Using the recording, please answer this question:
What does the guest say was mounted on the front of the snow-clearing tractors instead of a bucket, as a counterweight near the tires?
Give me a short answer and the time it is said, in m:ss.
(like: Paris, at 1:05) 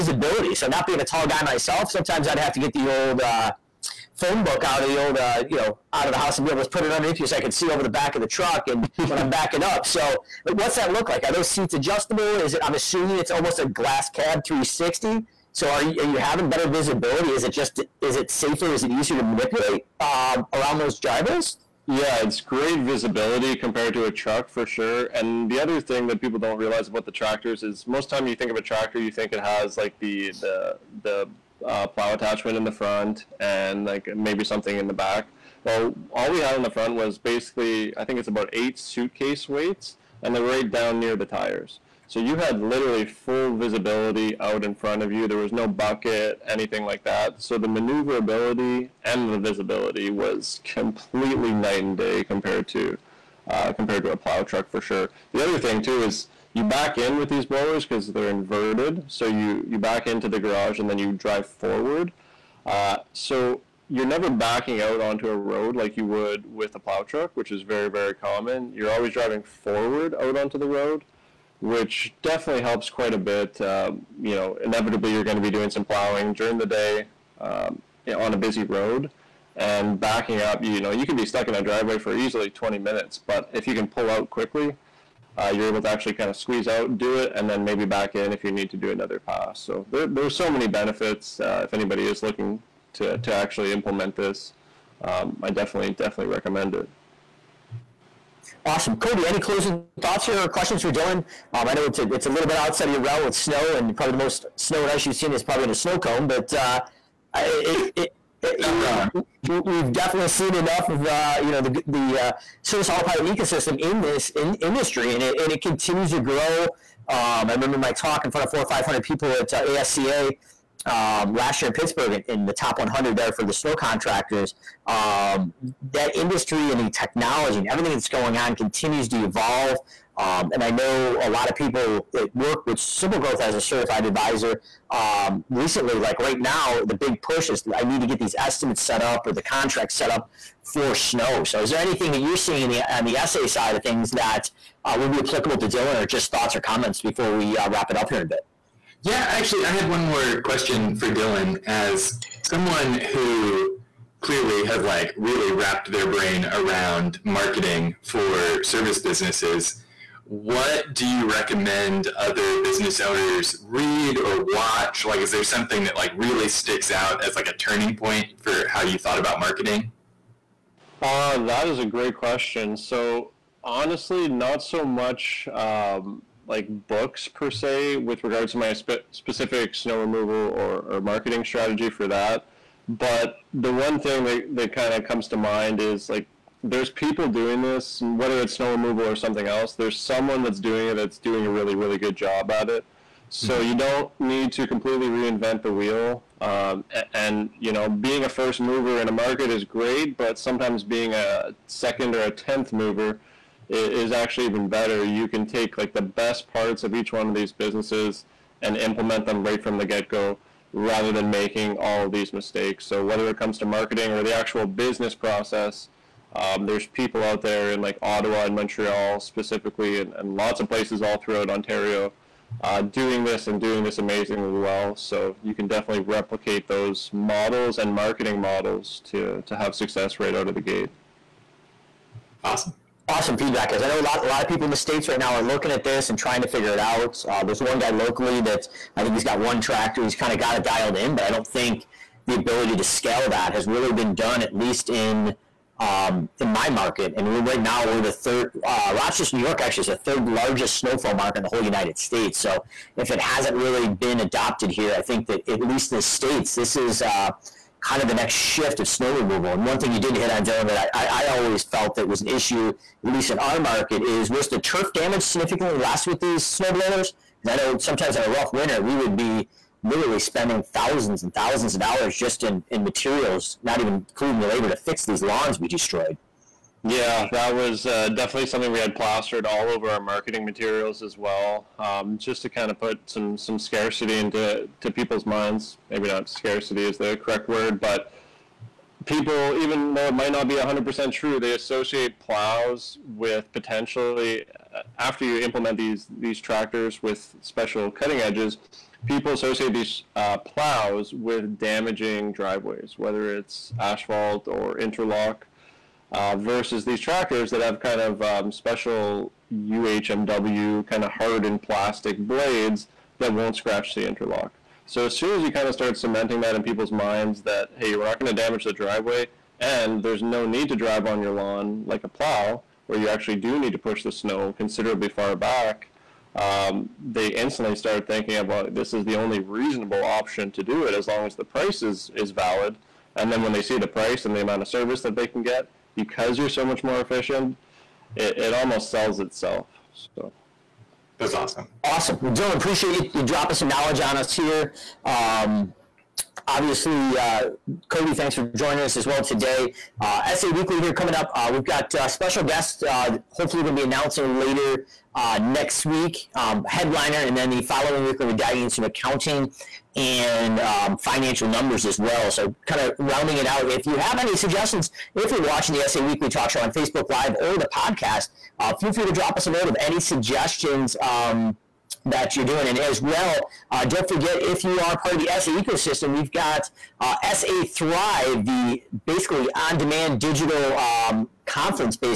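Suitcase weights, at 0:38.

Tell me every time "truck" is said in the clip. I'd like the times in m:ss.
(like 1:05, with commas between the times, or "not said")
0:08, 0:24, 0:54, 1:07.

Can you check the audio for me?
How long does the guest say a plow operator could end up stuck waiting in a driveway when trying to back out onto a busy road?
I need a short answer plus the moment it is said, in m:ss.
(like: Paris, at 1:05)
20 minutes, at 1:22.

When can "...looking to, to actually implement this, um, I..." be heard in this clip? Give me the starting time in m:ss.
1:32.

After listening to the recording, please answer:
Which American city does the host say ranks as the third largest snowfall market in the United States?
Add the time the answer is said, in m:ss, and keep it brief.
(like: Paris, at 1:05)
Rochester, New York, at 4:08.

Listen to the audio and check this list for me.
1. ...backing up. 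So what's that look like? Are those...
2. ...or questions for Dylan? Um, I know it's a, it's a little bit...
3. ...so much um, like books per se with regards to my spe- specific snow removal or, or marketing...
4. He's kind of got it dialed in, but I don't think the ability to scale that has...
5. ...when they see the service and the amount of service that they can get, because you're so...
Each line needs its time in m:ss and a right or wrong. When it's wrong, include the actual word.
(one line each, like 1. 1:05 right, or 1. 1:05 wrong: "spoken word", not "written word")
1. 0:09 right
2. 1:40 right
3. 2:54 right
4. 4:00 right
5. 5:33 wrong: "price", not "service".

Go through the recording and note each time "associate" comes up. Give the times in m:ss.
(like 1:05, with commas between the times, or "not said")
4:51, 4:59.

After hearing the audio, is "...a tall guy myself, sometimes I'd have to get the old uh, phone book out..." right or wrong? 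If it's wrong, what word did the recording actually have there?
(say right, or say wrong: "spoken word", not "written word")
right.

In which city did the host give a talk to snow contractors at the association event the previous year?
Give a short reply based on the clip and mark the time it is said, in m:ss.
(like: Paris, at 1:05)
Pittsburgh, at 2:01.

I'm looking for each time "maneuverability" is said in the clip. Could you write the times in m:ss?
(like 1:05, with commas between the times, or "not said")
0:47.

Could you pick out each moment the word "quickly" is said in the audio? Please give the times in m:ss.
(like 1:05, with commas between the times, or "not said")
1:24.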